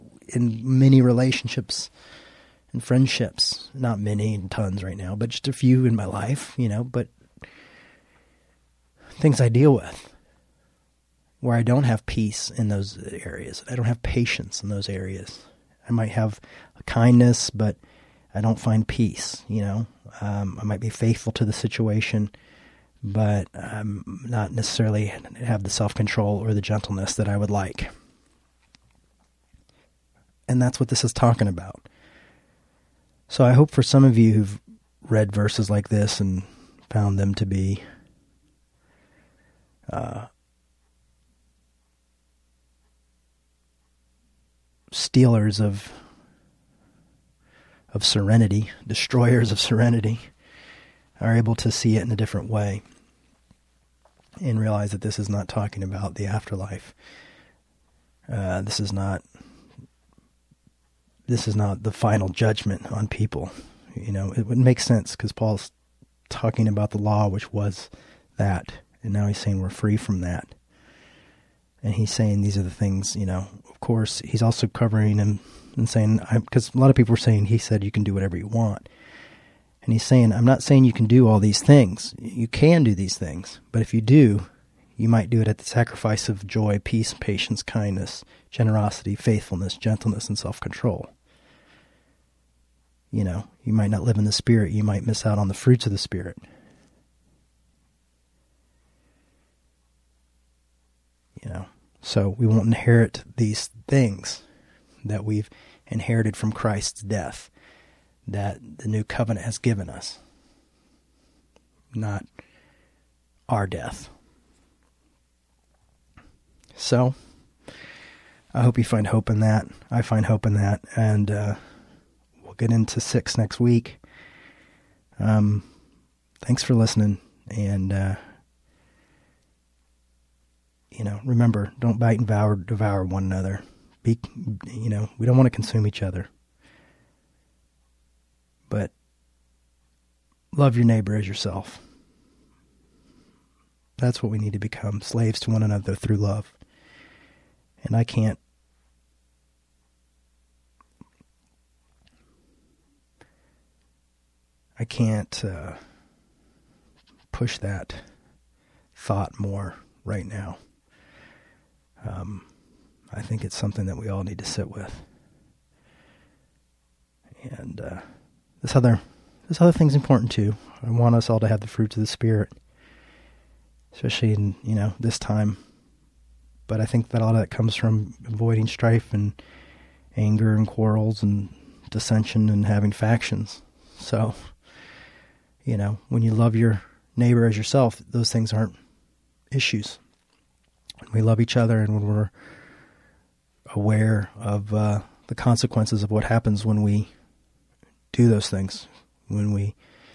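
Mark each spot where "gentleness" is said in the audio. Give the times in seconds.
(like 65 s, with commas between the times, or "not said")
26 s, 89 s.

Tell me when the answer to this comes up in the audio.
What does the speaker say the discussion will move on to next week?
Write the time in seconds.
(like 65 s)
122 s.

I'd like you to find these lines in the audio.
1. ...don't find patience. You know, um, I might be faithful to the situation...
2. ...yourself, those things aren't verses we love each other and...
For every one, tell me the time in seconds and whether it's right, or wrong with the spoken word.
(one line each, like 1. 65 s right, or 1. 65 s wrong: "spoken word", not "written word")
1. 18 s wrong: "peace", not "patience"
2. 187 s wrong: "issues", not "verses".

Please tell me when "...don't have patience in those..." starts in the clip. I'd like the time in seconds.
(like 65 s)
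13 s.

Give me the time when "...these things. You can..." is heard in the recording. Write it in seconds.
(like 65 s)
81 s.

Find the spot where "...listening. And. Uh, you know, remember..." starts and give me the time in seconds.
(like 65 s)
126 s.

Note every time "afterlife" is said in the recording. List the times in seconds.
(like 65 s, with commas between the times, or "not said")
56 s.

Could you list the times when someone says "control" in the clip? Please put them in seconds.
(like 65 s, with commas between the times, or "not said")
25 s, 90 s.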